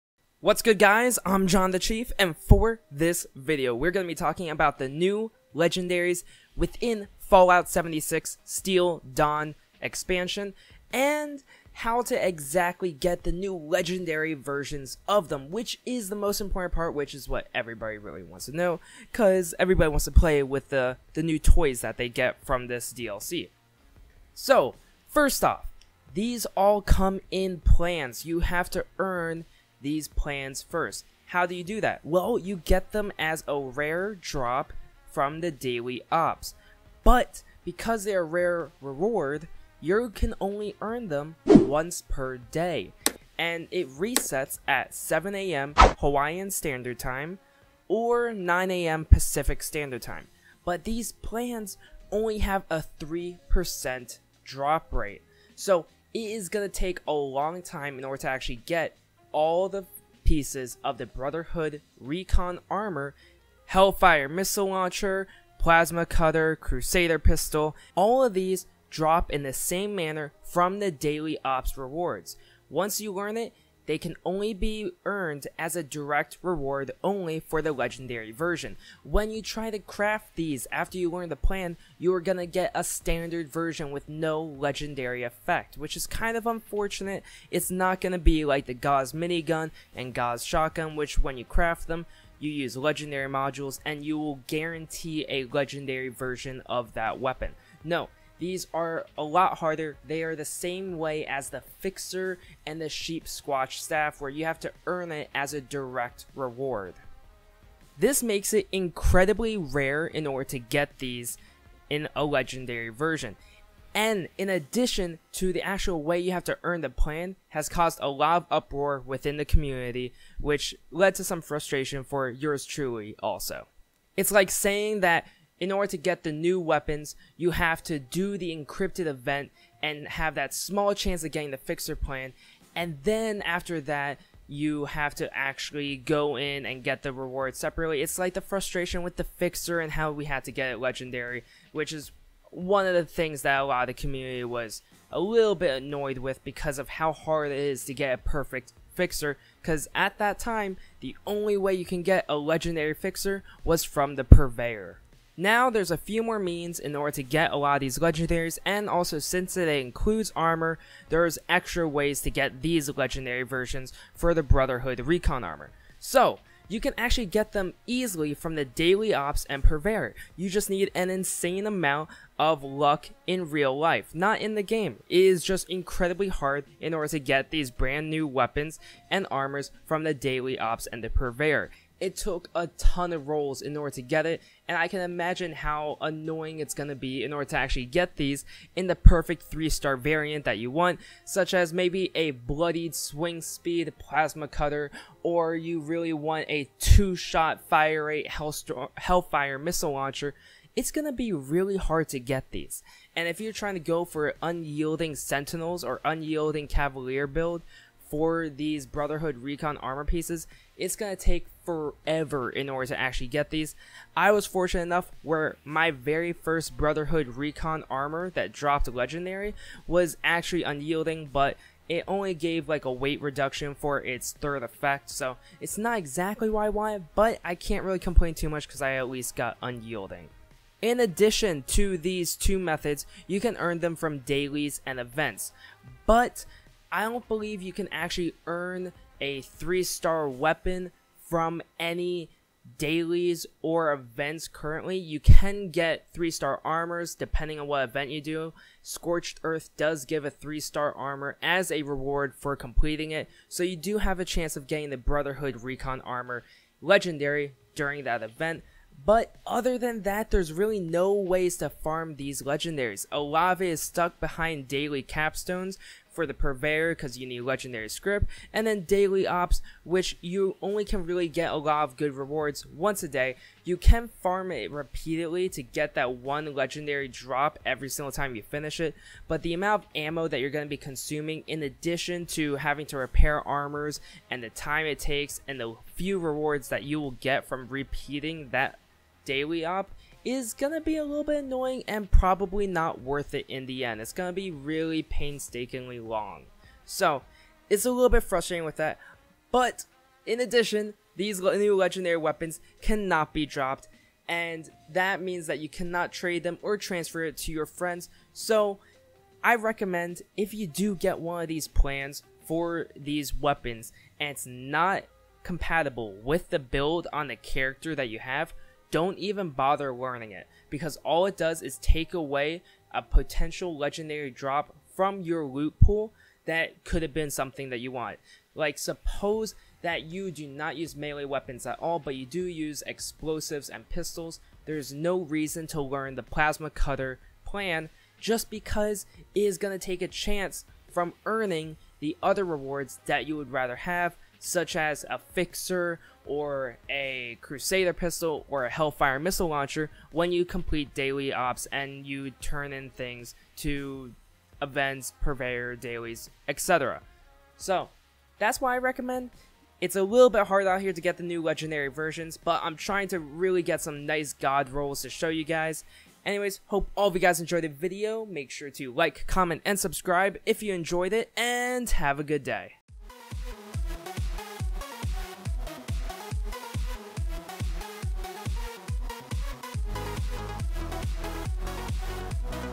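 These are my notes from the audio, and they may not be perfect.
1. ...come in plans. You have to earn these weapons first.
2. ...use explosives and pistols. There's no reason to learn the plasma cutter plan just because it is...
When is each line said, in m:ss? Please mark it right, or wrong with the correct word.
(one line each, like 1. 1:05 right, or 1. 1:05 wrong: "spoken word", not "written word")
1. 0:26 wrong: "plans", not "weapons"
2. 5:32 right.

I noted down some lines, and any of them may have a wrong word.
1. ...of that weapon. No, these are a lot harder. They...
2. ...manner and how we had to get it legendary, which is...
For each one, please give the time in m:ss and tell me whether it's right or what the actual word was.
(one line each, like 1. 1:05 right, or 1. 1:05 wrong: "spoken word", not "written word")
1. 1:36 right
2. 2:19 wrong: "fixer", not "manner".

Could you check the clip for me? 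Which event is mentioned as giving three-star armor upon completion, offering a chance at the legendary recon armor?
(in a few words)
Scorched Earth.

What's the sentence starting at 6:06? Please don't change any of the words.
Anyways, hope all of you guys enjoyed the video.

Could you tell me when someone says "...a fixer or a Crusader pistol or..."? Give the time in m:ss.
5:45.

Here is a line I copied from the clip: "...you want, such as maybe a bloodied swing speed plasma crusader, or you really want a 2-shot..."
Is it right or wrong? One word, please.
wrong.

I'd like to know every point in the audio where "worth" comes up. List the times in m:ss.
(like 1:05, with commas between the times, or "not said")
4:53.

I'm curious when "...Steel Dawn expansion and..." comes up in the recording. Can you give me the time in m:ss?
0:08.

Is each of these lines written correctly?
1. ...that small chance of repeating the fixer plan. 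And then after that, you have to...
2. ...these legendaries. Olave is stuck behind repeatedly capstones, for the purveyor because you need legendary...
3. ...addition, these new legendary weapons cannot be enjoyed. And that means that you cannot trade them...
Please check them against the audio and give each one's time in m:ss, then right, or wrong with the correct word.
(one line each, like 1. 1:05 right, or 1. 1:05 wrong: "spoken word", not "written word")
1. 2:10 wrong: "getting", not "repeating"
2. 4:22 wrong: "daily", not "repeatedly"
3. 5:00 wrong: "dropped", not "enjoyed".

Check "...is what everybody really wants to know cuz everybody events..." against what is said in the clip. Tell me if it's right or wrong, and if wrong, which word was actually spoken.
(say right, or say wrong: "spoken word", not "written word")
wrong: "wants", not "events".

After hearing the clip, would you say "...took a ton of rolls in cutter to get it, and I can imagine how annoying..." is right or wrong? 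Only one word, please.
wrong.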